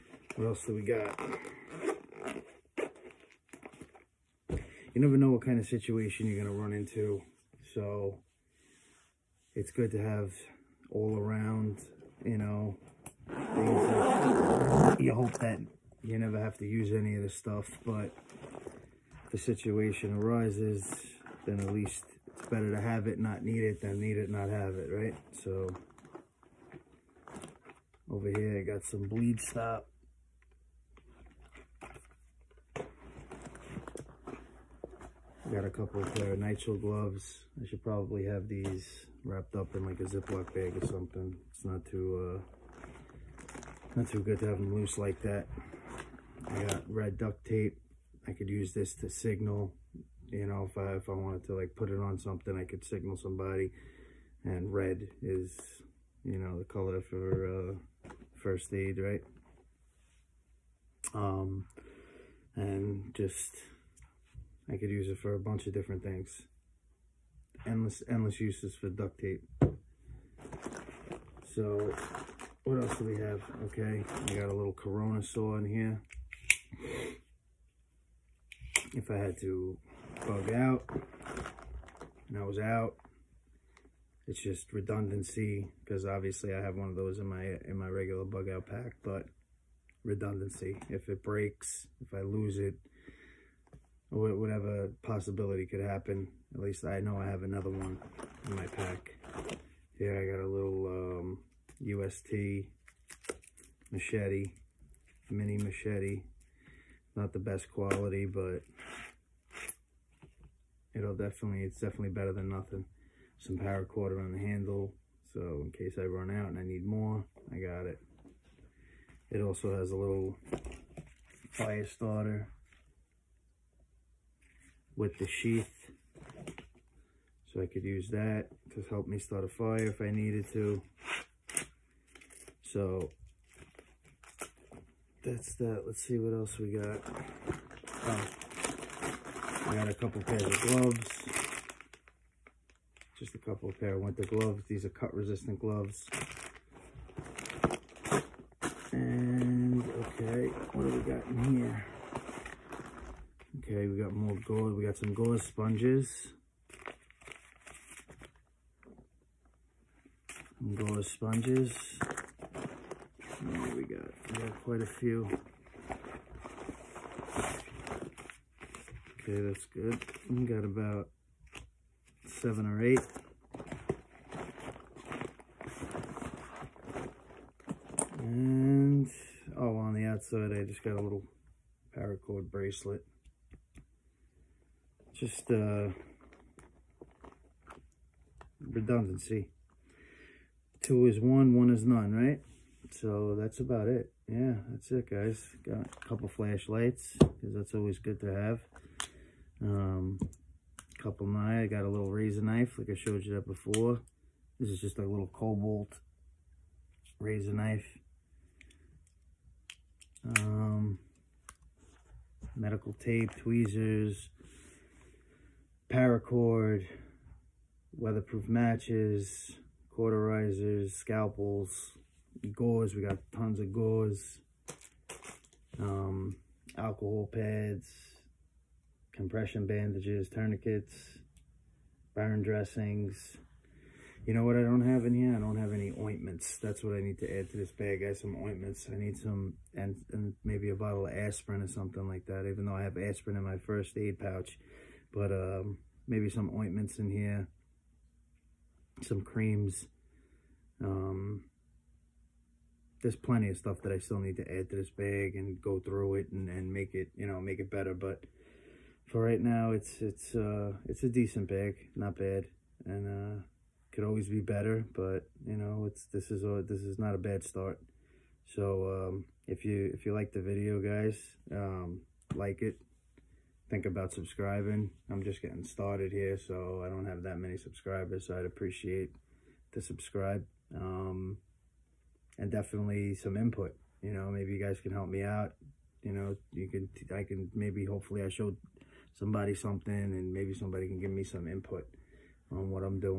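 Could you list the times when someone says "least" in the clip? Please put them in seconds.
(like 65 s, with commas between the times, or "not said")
21 s, 96 s.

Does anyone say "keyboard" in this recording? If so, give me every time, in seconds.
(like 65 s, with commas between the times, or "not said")
not said.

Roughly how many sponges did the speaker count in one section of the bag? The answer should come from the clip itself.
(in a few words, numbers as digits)
7 or 8.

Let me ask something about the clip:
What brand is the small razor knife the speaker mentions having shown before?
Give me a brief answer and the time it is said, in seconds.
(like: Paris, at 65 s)
Kobalt, at 205 s.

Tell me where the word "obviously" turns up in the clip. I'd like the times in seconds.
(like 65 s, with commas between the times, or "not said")
86 s.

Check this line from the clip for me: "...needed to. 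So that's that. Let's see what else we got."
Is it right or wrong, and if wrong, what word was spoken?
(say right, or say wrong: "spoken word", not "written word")
right.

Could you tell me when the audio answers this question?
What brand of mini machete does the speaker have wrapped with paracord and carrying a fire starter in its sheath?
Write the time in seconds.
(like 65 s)
101 s.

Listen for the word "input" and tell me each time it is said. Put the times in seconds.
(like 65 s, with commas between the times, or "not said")
283 s, 291 s.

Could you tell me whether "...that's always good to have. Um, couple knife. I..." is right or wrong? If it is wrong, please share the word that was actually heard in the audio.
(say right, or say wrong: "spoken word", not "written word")
right.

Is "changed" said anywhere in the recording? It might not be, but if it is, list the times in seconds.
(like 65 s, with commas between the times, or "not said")
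not said.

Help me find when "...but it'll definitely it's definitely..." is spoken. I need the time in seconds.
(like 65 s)
108 s.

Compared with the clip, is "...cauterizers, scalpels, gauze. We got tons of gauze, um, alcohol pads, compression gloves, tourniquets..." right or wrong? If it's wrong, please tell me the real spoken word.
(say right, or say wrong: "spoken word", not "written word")
wrong: "bandages", not "gloves".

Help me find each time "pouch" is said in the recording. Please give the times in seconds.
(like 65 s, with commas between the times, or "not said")
244 s.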